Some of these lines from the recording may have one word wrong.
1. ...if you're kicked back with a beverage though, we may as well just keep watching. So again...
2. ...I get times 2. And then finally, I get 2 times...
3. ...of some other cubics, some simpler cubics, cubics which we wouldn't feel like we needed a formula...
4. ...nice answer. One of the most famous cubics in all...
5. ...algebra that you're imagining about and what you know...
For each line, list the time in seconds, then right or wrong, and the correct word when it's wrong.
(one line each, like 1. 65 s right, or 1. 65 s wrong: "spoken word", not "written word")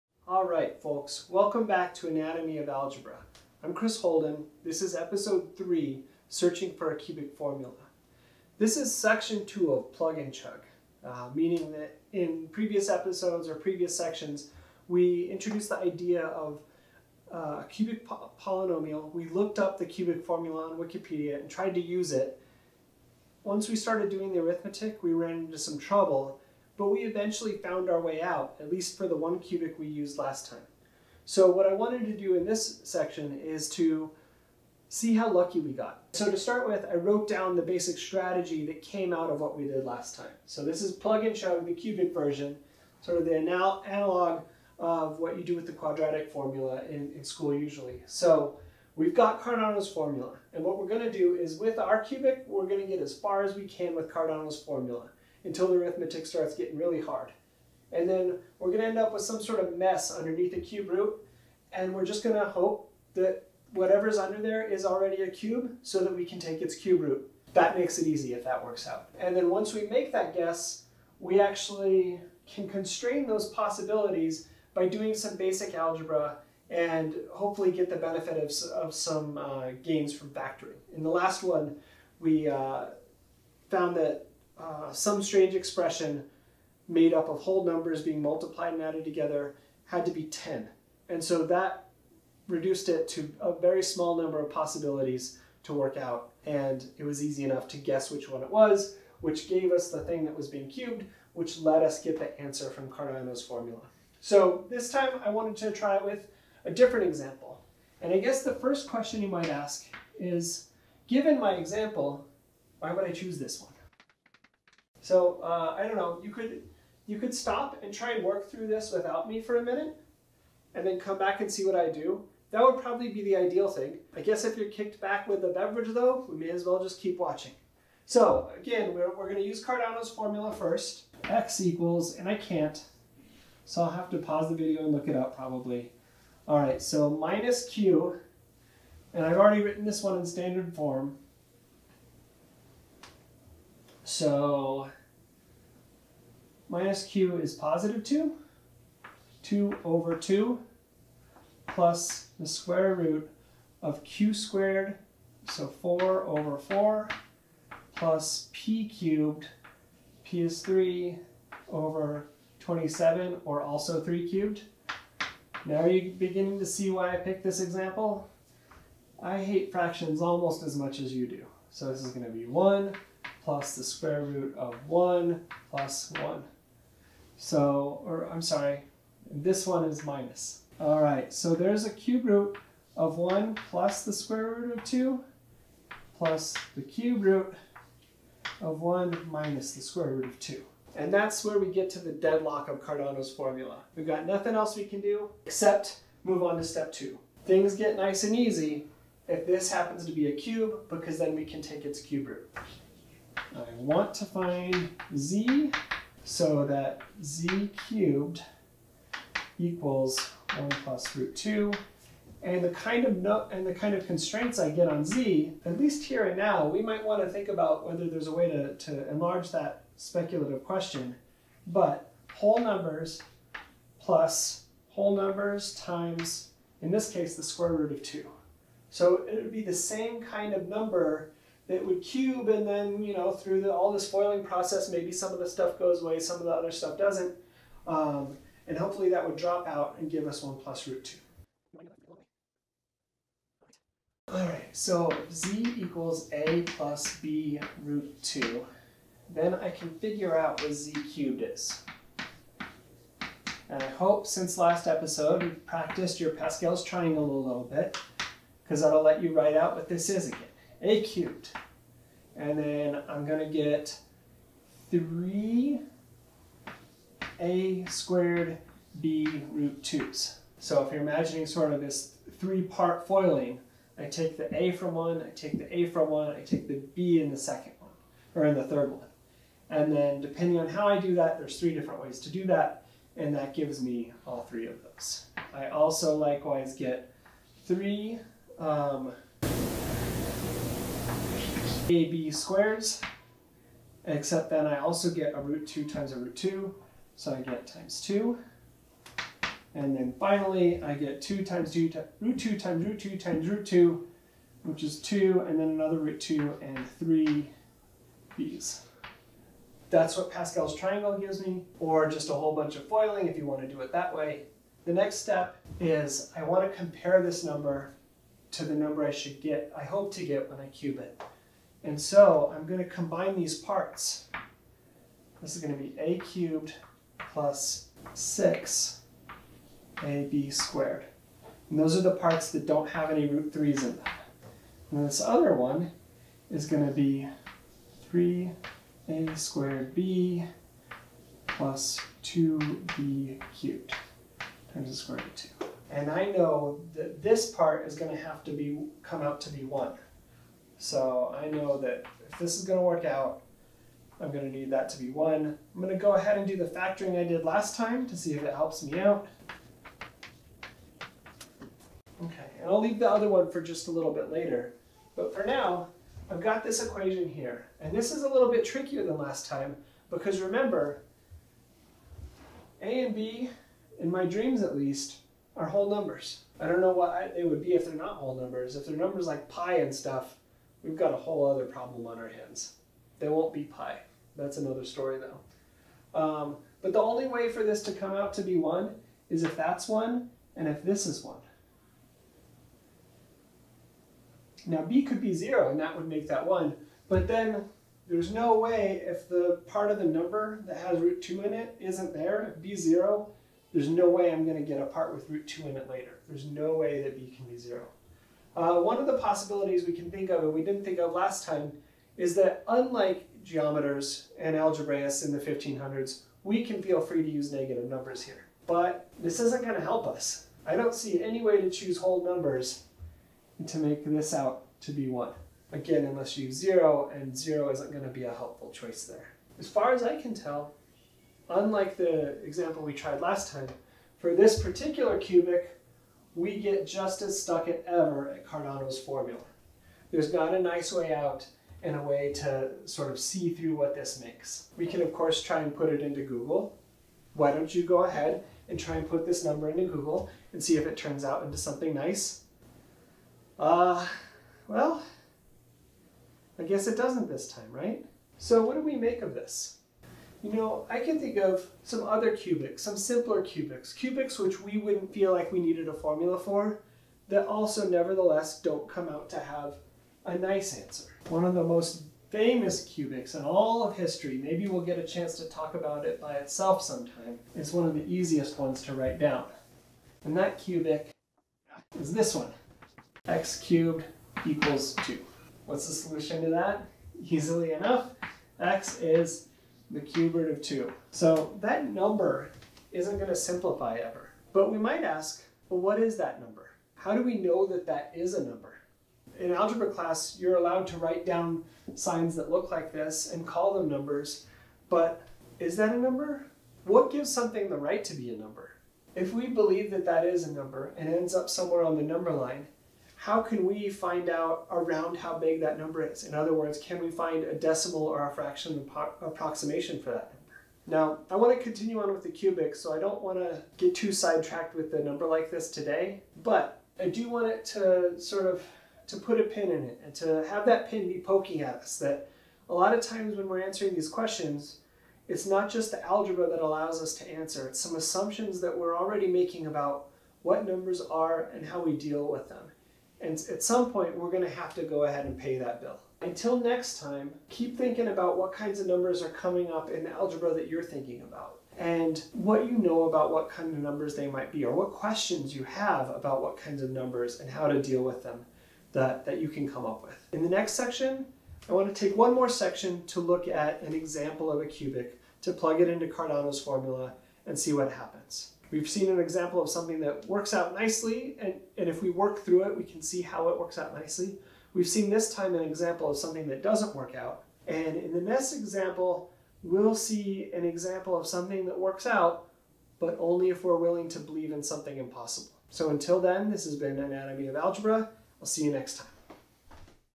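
1. 124 s right
2. 297 s right
3. 461 s right
4. 470 s right
5. 550 s wrong: "thinking", not "imagining".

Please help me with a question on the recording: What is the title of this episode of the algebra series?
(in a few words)
Searching for a Cubic Formula.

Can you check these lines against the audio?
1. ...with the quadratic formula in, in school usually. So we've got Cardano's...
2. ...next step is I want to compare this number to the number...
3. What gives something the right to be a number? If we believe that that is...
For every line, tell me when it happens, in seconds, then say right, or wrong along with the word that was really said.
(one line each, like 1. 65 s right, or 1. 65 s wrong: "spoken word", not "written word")
1. 45 s right
2. 314 s right
3. 506 s right.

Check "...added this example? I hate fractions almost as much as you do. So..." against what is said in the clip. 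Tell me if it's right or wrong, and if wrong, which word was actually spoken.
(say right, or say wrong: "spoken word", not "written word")
wrong: "picked", not "added".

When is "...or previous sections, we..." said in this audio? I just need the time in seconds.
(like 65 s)
13 s.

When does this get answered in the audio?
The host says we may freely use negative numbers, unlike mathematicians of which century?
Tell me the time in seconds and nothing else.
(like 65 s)
415 s.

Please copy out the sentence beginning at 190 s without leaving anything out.
And that's where we get to the deadlock of Cardano's formula.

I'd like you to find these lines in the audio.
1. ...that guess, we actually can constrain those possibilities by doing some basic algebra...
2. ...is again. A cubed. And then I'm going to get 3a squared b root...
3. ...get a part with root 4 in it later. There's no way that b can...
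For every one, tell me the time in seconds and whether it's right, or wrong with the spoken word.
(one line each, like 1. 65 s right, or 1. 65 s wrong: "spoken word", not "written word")
1. 70 s right
2. 260 s right
3. 404 s wrong: "2", not "4".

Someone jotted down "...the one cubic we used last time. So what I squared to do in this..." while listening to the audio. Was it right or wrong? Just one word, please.
wrong.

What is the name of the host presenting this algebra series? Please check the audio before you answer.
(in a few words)
Chris Holden.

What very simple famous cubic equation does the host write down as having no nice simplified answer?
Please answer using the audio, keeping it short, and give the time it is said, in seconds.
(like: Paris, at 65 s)
x cubed equals 2, at 483 s.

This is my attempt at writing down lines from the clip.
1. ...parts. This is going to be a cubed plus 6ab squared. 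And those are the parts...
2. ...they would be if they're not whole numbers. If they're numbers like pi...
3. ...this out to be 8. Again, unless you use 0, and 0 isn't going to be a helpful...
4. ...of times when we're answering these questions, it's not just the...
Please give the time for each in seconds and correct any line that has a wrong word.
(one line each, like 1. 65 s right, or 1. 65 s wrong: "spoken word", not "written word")
1. 323 s right
2. 377 s right
3. 424 s wrong: "1", not "8"
4. 532 s right.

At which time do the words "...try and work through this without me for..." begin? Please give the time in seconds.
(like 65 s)
117 s.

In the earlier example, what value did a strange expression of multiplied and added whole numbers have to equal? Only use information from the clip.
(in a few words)
10.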